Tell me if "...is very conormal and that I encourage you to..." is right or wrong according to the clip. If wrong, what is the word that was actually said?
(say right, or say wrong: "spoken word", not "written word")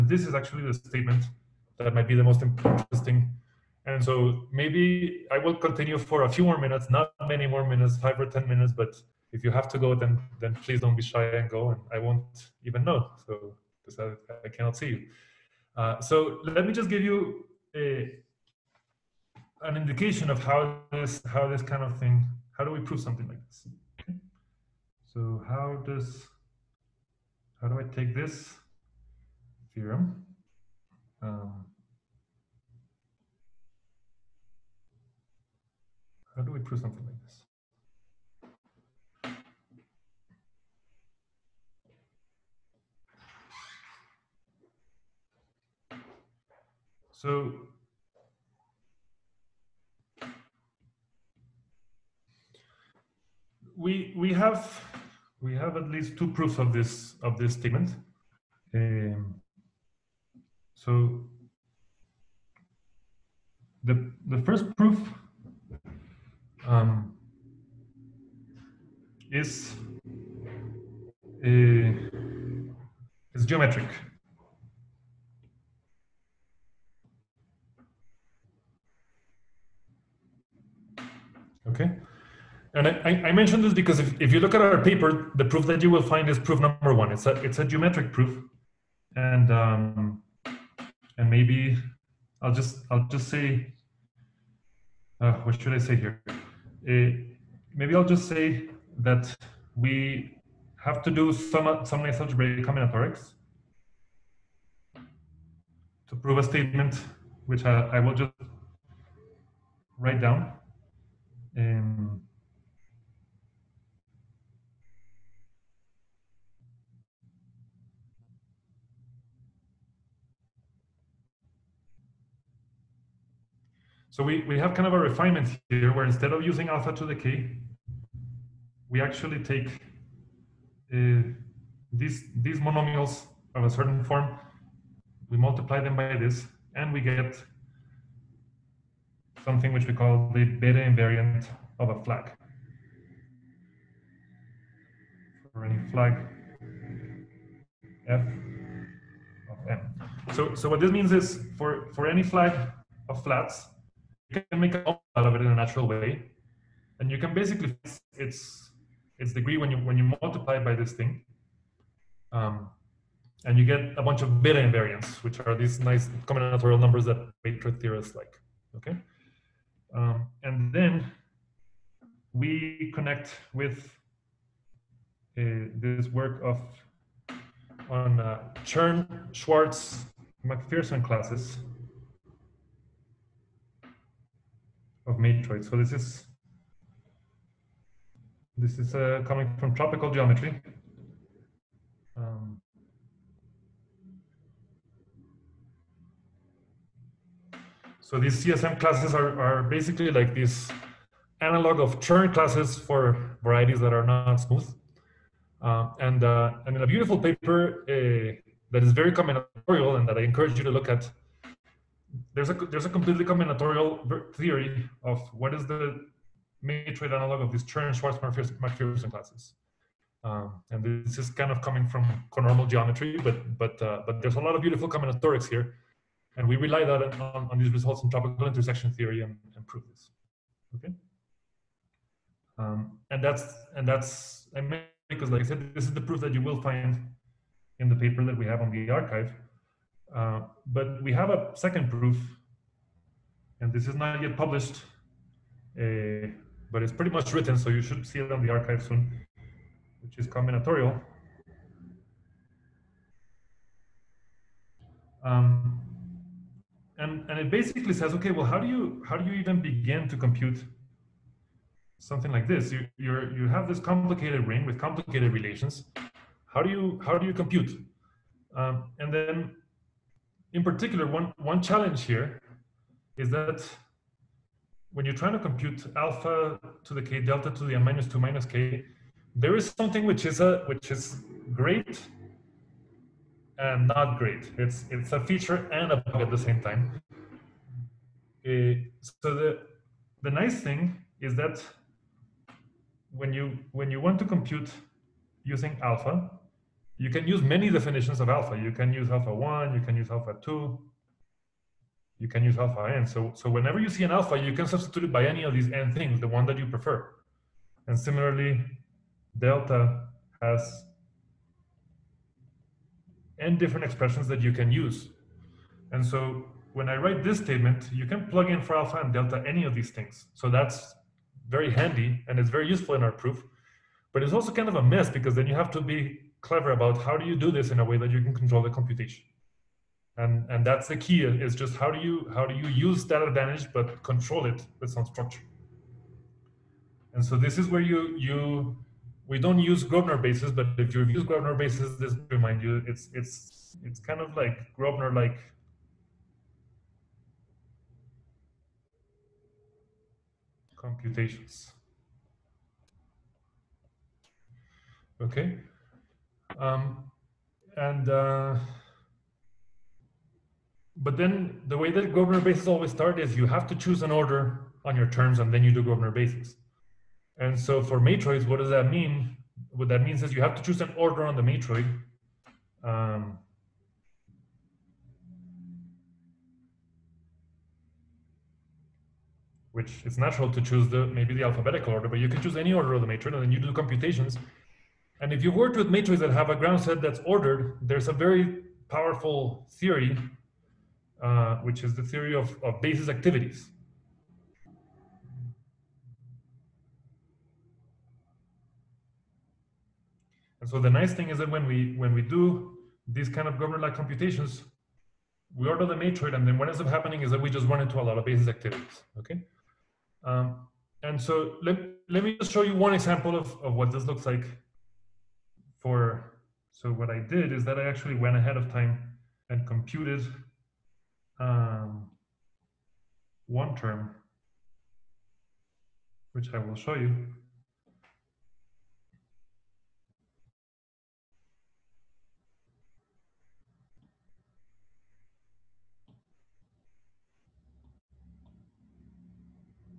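wrong: "combinatorial", not "conormal".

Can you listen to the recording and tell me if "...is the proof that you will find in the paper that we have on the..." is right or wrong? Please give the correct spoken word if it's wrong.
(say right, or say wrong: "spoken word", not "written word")
right.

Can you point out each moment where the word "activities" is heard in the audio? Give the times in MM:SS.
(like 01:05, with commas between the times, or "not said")
06:33, 06:48.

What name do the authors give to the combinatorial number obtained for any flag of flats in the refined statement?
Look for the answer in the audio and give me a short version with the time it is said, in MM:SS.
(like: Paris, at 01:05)
beta invariant, at 02:20.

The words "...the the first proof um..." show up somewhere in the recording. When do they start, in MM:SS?
01:03.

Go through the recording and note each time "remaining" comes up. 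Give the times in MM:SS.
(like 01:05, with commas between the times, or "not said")
not said.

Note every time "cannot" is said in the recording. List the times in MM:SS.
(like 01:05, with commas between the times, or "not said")
00:14.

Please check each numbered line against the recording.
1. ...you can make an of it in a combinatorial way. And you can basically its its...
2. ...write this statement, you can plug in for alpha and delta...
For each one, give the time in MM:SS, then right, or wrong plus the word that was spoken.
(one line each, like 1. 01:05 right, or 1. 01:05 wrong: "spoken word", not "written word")
1. 02:34 wrong: "natural", not "combinatorial"
2. 05:16 right.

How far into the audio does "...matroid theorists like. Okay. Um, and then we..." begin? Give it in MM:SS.
02:47.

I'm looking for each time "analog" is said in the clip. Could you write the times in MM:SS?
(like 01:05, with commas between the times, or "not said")
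03:21, 03:37.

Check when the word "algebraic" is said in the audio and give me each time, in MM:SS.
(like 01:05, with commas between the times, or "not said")
01:42.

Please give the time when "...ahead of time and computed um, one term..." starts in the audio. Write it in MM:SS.
06:58.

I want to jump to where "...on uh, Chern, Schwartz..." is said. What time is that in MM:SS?
02:57.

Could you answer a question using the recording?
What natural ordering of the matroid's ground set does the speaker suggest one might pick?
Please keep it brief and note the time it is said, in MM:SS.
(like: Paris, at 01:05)
alphabetical order, at 06:21.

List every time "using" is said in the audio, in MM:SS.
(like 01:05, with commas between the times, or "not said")
02:06, 04:55.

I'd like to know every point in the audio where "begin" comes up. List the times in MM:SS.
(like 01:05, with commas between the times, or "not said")
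04:19.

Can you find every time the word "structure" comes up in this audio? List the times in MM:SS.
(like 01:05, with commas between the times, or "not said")
05:35.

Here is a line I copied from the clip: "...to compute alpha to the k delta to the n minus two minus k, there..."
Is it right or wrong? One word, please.
right.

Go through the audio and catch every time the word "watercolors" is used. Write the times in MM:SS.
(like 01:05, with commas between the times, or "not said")
not said.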